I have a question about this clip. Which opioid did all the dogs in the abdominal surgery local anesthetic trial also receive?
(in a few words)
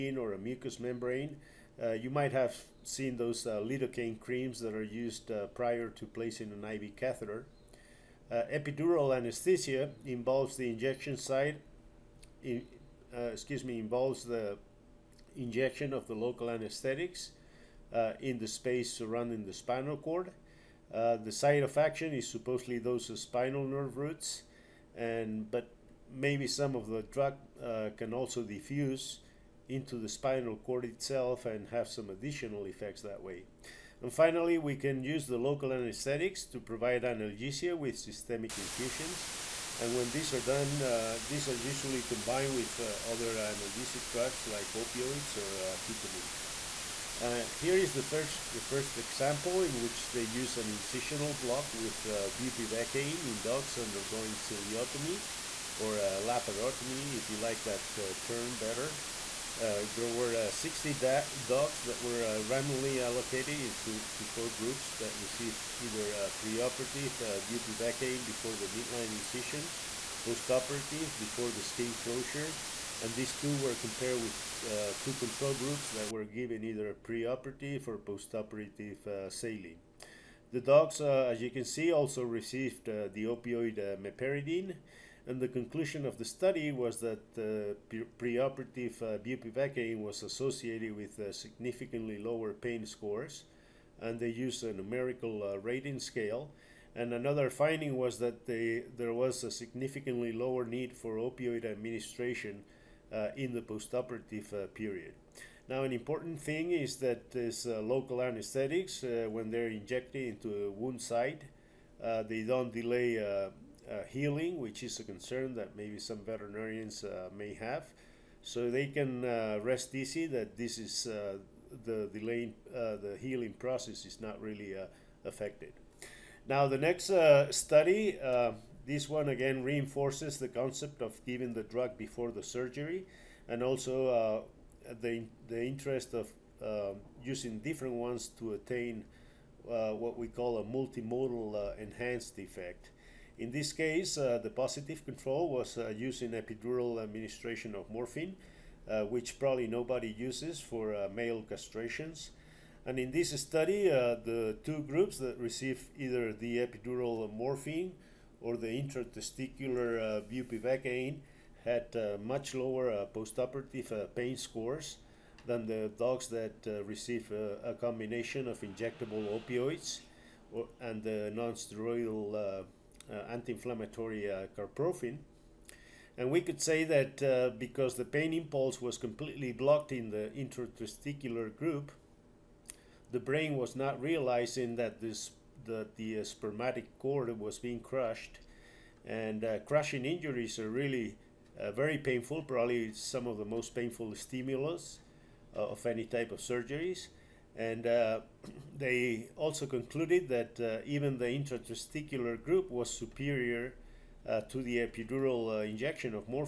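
meperidine.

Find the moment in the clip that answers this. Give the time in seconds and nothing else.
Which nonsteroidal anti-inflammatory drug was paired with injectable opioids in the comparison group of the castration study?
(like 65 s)
174 s.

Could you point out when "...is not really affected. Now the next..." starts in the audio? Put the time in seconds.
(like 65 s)
124 s.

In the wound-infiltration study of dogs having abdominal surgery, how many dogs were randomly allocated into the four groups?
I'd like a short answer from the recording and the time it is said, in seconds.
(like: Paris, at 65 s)
60, at 60 s.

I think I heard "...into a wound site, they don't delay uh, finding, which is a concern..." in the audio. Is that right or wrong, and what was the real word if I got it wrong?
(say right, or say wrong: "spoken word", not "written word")
wrong: "healing", not "finding".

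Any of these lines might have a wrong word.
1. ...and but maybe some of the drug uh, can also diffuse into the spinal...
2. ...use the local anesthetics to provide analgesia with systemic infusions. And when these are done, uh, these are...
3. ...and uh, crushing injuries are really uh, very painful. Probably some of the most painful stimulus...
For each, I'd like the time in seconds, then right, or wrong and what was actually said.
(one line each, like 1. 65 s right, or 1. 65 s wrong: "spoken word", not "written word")
1. 24 s right
2. 35 s right
3. 189 s right.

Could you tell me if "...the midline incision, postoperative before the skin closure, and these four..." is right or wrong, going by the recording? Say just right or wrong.
wrong.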